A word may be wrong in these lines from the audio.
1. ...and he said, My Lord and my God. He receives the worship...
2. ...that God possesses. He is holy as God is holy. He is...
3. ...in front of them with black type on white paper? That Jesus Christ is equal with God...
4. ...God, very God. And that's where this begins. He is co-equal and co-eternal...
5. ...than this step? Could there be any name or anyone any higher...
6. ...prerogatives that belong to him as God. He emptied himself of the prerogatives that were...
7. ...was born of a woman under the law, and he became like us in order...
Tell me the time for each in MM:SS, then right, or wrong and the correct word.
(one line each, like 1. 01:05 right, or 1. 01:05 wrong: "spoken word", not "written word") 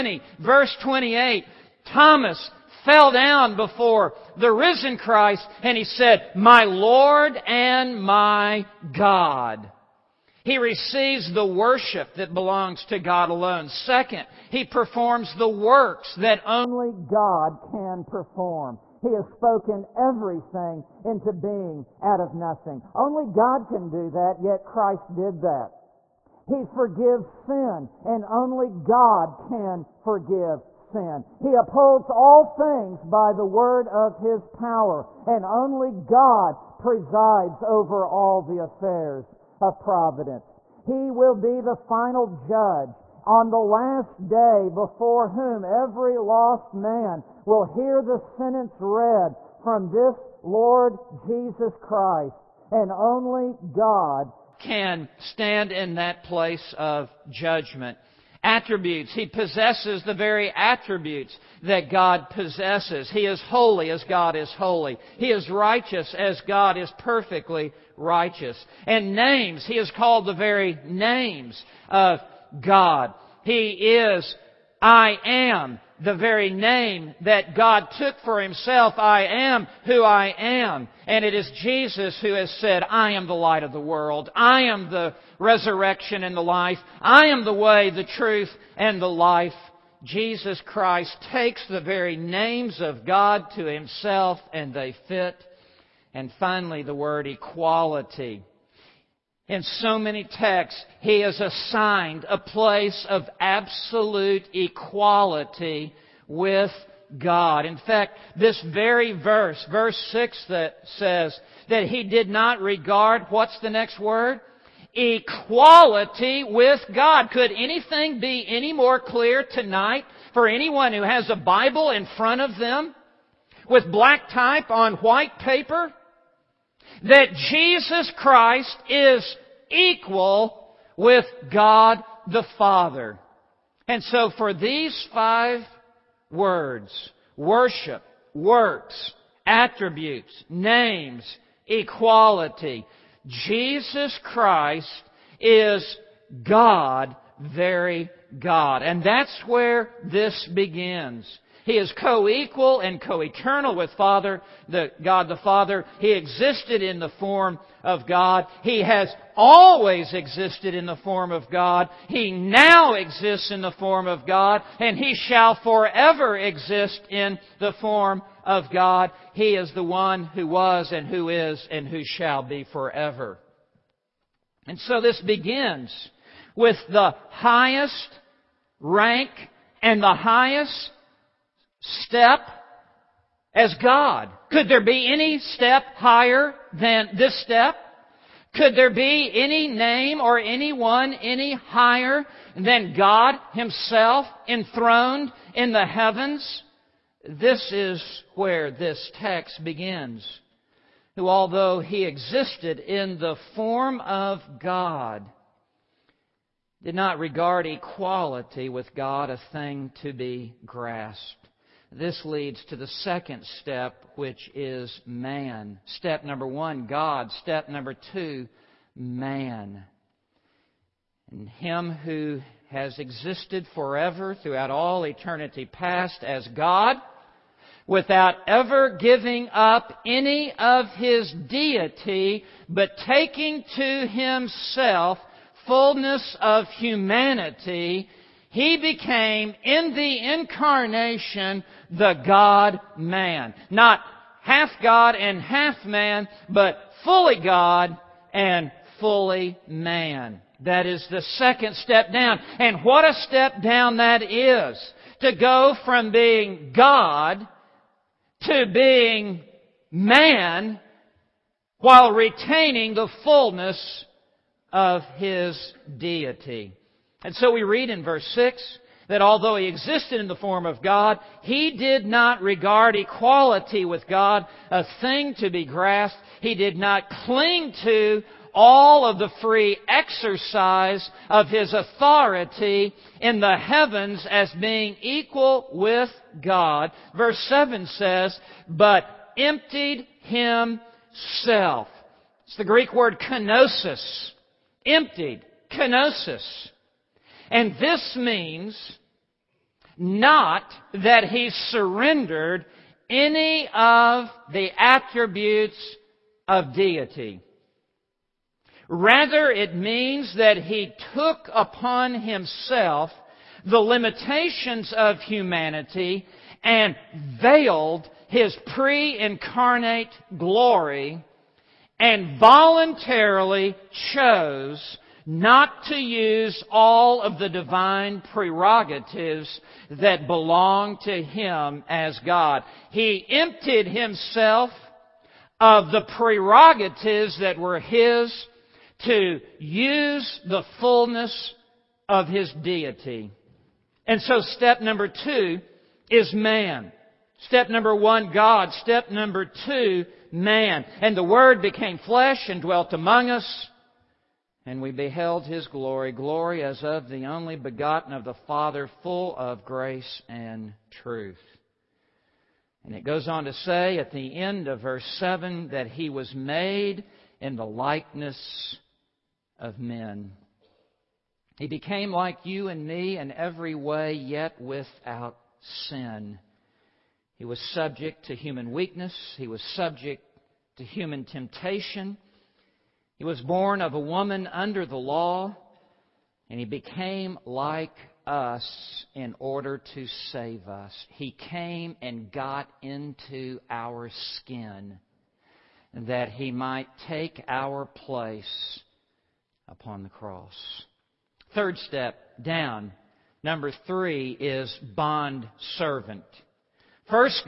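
1. 00:05 right
2. 01:01 right
3. 02:01 right
4. 02:26 right
5. 03:06 right
6. 05:28 right
7. 06:23 right.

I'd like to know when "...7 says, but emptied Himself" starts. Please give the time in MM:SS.
04:47.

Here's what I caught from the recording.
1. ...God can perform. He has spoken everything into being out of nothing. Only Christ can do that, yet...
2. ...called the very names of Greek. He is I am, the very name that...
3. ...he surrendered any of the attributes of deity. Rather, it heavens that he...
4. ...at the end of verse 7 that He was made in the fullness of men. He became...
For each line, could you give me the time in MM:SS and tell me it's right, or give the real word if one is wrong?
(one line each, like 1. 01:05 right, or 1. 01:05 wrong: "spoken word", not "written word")
1. 00:16 wrong: "God", not "Christ"
2. 01:09 wrong: "God", not "Greek"
3. 05:01 wrong: "means", not "heavens"
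4. 06:03 wrong: "likeness", not "fullness".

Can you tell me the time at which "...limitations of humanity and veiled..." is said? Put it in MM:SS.
05:13.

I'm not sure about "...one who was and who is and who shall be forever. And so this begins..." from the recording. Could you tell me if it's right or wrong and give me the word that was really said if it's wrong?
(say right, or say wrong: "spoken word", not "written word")
right.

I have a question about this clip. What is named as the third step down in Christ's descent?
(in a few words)
bond servant.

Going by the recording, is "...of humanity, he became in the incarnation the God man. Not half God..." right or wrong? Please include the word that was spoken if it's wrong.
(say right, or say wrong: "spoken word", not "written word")
right.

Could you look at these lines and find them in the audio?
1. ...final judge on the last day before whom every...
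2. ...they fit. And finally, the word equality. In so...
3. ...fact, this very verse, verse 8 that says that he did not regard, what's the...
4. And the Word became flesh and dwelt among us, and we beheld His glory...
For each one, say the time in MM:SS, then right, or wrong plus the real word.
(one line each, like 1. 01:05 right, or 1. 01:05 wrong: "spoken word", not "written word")
1. 00:41 right
2. 01:34 right
3. 01:47 wrong: "6", not "8"
4. 05:51 right.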